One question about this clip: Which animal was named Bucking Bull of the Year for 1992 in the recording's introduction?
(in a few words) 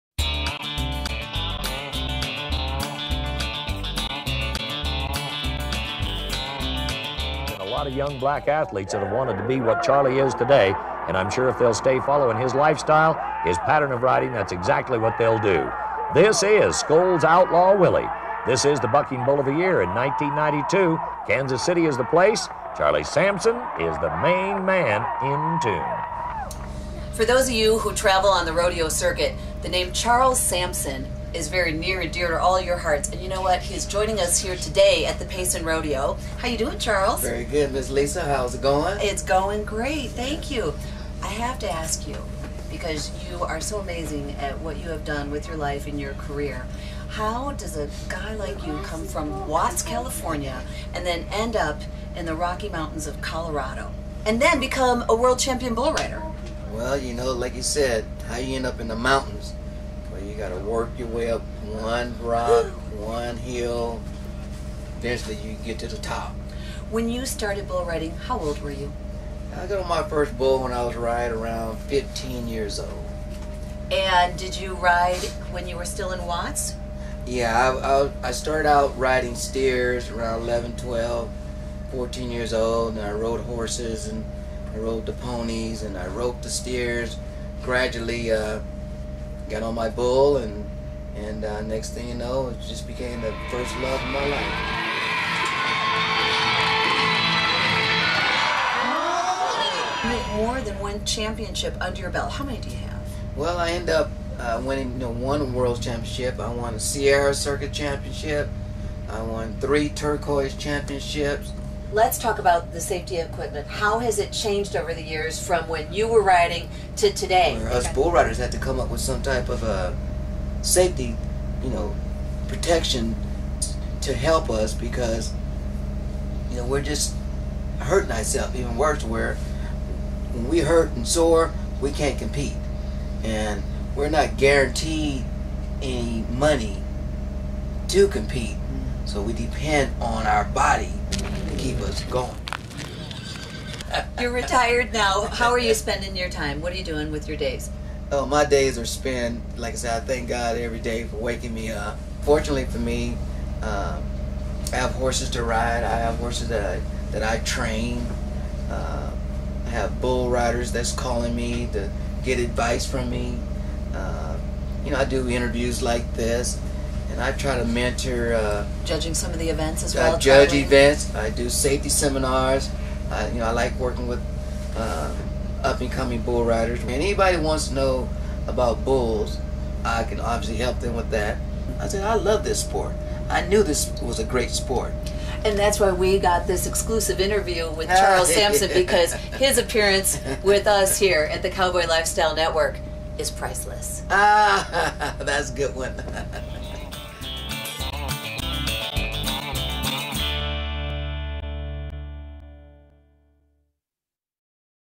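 Scholes Outlaw Willie.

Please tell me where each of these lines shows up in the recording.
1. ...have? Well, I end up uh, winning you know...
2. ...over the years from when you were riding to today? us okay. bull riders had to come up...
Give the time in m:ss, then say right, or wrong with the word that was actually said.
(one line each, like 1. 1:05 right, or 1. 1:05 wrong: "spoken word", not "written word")
1. 1:42 right
2. 1:54 right.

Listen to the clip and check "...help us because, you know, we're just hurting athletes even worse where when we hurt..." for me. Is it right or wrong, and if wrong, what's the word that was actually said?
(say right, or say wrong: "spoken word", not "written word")
wrong: "ourselves", not "athletes".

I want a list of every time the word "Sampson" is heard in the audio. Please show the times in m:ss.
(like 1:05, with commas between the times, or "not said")
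0:23, 0:30, 3:08.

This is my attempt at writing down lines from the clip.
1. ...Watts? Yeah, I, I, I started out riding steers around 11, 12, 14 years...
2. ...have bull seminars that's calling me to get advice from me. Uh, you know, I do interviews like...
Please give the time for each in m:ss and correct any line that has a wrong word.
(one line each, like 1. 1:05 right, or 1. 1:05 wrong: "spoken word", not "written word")
1. 1:16 right
2. 2:39 wrong: "riders", not "seminars".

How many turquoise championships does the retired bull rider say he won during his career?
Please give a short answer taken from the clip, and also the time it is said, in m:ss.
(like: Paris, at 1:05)
3, at 1:49.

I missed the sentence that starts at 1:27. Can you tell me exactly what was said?
Gradually, uh, got on my bull, and and uh, next thing you know, it just became the first love of my life.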